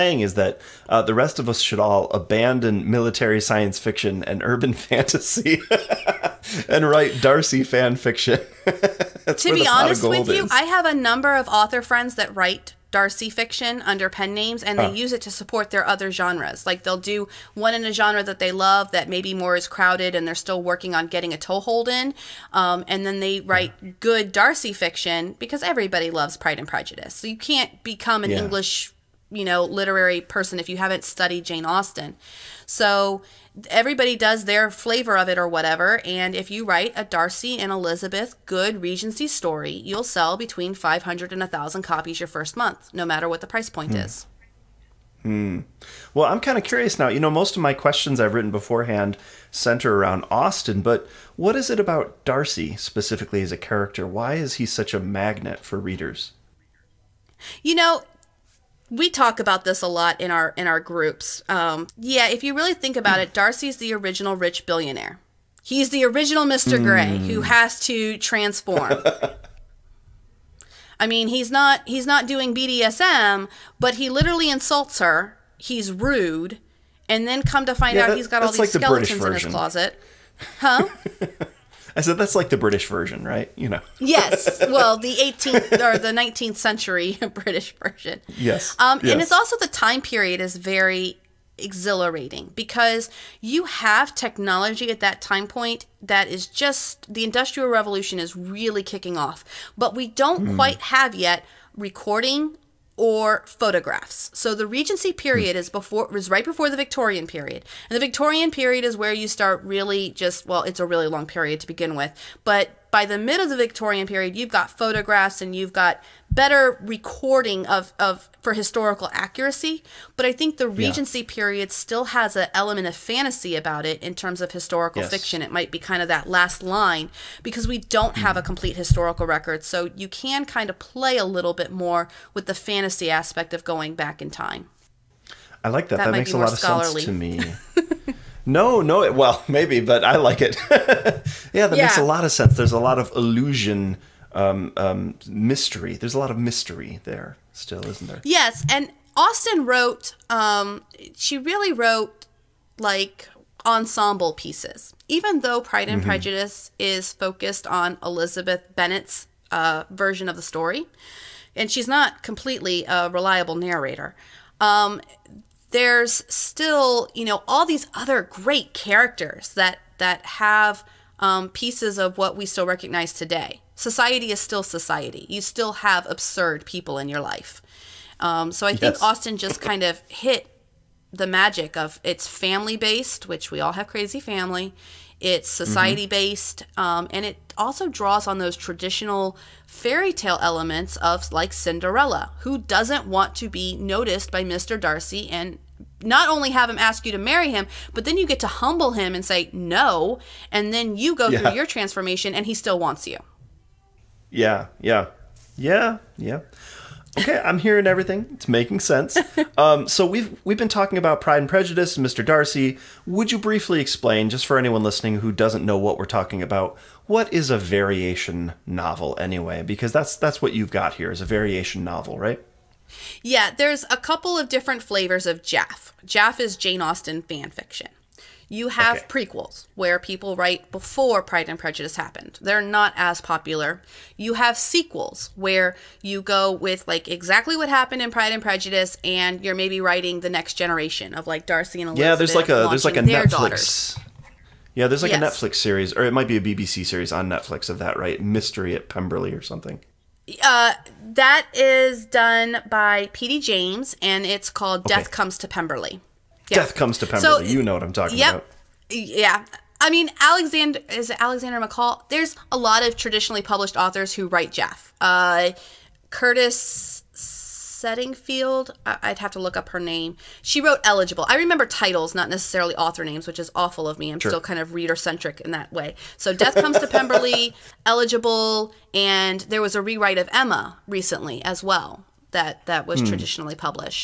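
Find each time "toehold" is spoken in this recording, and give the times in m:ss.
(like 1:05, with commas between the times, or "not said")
0:21.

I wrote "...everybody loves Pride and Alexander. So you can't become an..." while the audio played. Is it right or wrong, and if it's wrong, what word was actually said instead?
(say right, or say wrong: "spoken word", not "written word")
wrong: "Prejudice", not "Alexander".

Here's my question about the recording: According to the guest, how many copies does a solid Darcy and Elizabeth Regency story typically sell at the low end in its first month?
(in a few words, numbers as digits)
500.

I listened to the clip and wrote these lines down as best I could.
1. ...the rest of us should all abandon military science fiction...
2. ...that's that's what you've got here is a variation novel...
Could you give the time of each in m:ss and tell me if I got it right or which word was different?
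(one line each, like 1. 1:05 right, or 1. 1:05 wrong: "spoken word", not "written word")
1. 0:00 right
2. 3:39 right.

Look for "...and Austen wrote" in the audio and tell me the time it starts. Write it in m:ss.
2:28.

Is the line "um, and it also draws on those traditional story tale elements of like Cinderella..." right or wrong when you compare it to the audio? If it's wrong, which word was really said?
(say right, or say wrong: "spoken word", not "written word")
wrong: "fairy", not "story".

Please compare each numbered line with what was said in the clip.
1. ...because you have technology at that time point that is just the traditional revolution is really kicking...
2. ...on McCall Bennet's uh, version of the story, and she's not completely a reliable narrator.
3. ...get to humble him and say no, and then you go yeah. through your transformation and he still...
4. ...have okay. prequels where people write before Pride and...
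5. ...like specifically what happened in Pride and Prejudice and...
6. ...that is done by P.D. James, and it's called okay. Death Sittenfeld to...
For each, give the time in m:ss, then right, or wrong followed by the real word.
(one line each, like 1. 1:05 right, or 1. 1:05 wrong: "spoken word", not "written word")
1. 1:32 wrong: "industrial", not "traditional"
2. 2:37 wrong: "Elizabeth", not "McCall"
3. 3:18 right
4. 3:48 right
5. 3:56 wrong: "exactly", not "specifically"
6. 4:11 wrong: "Comes", not "Sittenfeld".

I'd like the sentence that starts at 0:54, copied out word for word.
Why is he such a magnet for readers?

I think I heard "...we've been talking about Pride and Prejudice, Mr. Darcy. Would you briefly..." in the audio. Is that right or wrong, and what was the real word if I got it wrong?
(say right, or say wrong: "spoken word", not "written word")
right.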